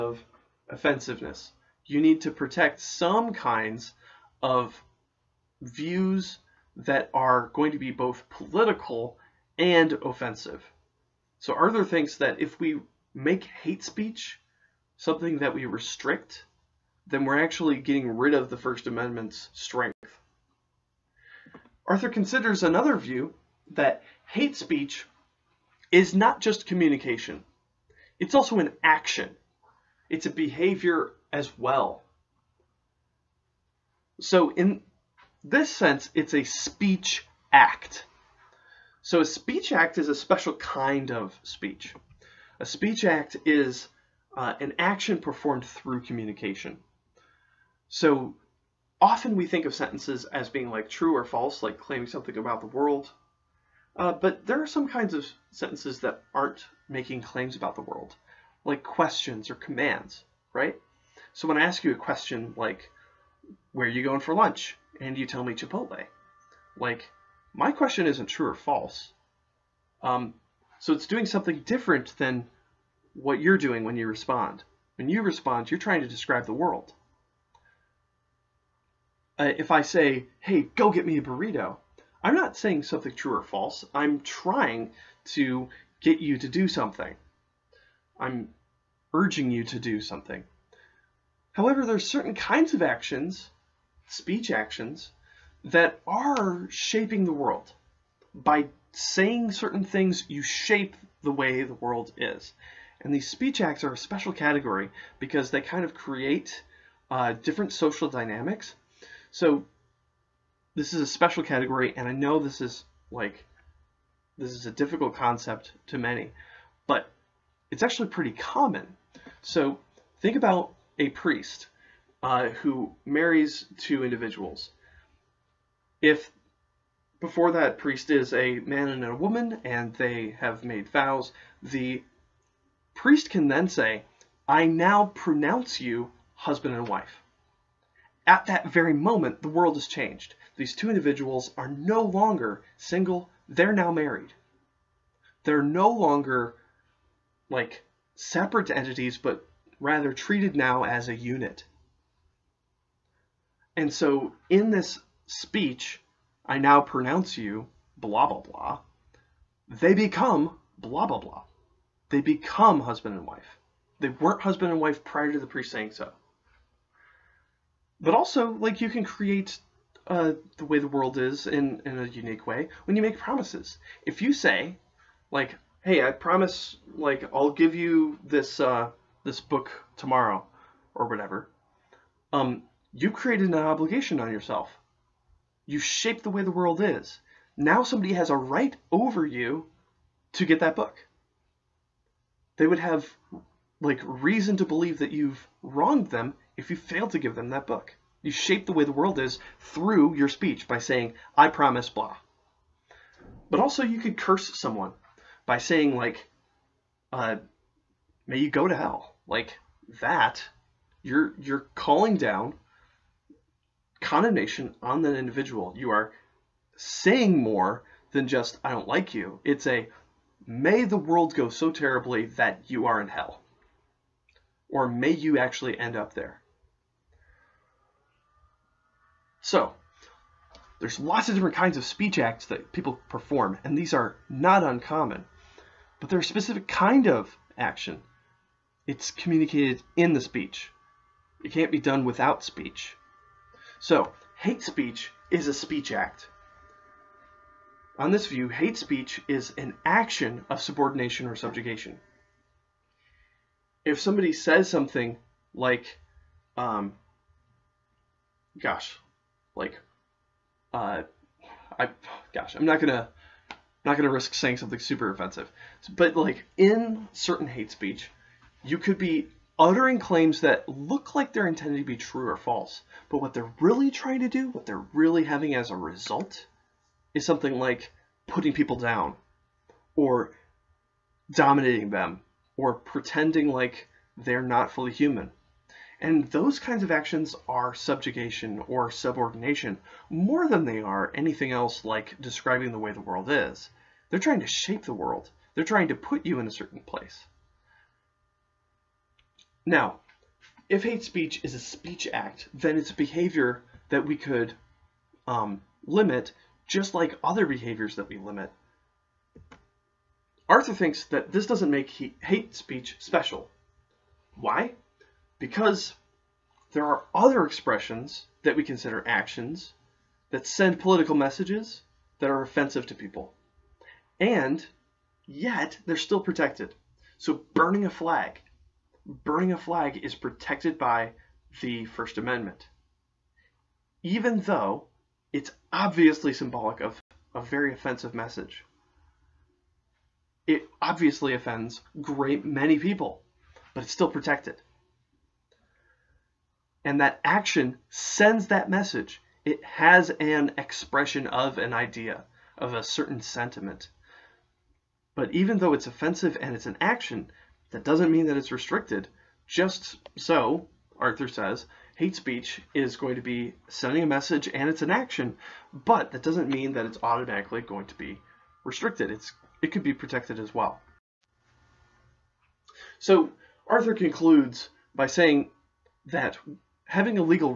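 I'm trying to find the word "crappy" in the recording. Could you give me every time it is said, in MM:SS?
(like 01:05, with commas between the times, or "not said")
not said.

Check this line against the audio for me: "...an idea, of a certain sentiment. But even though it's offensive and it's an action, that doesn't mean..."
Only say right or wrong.
right.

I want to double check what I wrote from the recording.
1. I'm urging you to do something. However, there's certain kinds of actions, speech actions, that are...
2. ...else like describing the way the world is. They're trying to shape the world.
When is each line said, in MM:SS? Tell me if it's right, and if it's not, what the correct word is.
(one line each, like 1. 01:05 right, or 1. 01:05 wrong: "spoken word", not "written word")
1. 01:28 right
2. 04:51 right.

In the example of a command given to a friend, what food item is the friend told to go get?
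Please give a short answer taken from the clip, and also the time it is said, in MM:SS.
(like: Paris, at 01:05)
a burrito, at 01:21.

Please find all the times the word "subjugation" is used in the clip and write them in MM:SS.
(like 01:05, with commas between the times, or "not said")
04:11, 04:47.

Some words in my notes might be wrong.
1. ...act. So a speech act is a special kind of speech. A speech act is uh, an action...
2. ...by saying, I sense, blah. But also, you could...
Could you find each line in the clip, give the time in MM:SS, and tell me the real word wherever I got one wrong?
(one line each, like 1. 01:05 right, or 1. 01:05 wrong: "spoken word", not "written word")
1. 00:37 right
2. 03:20 wrong: "promise", not "sense".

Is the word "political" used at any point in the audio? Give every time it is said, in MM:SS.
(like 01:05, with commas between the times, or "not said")
00:08, 05:20.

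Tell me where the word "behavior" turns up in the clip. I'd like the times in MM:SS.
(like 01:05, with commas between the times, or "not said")
00:30, 05:03, 05:07.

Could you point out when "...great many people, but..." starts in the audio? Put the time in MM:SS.
05:42.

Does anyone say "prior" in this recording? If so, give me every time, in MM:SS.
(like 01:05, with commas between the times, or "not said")
02:45.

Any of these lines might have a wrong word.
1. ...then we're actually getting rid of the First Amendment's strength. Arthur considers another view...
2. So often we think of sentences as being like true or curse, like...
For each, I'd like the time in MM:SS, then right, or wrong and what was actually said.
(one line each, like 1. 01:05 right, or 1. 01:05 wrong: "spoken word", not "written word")
1. 00:17 right
2. 00:47 wrong: "false", not "curse".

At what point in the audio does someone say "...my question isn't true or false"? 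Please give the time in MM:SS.
01:07.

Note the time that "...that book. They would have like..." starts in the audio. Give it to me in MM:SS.
03:10.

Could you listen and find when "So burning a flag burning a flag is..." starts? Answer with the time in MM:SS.
05:27.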